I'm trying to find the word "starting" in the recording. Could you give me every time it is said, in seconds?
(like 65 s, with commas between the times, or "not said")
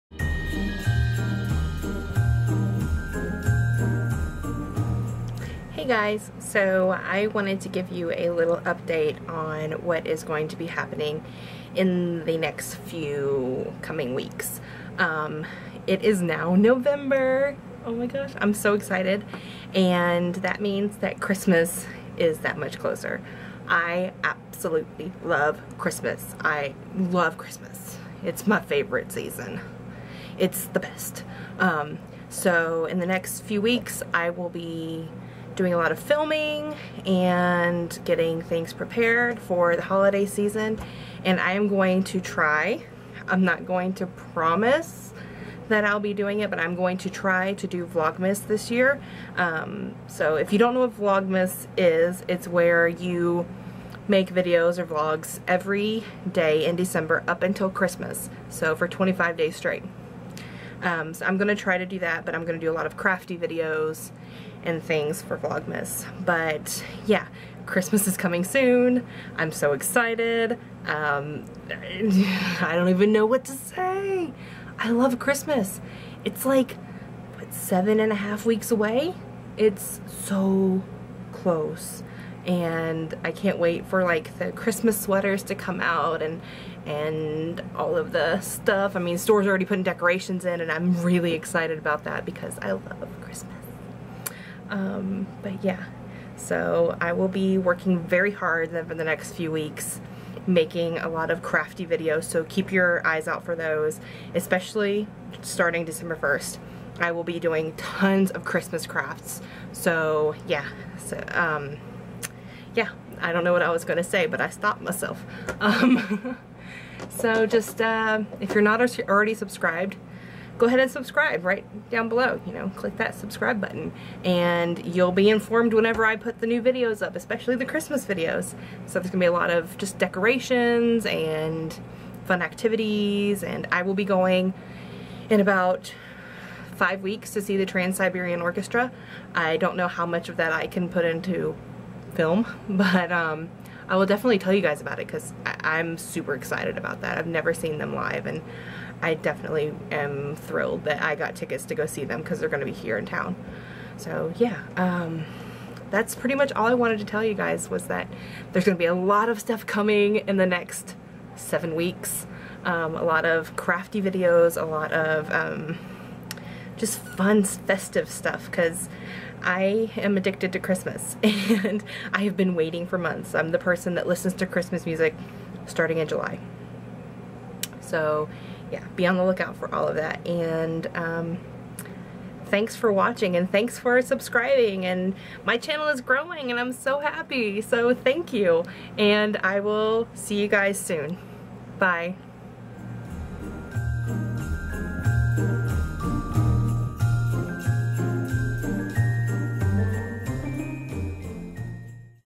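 105 s, 175 s.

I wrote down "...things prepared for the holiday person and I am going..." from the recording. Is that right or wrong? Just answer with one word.
wrong.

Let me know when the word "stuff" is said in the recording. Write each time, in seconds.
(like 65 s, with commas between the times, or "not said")
88 s, 159 s, 168 s.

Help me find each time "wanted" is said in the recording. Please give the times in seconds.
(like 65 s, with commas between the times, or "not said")
7 s, 156 s.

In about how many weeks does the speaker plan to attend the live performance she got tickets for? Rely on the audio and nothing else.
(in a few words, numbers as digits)
5 weeks.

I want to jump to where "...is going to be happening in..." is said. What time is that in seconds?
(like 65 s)
10 s.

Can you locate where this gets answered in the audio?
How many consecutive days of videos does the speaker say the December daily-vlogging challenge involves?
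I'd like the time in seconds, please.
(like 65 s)
58 s.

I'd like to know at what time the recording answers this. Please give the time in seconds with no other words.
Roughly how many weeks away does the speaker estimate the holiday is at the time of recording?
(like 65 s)
77 s.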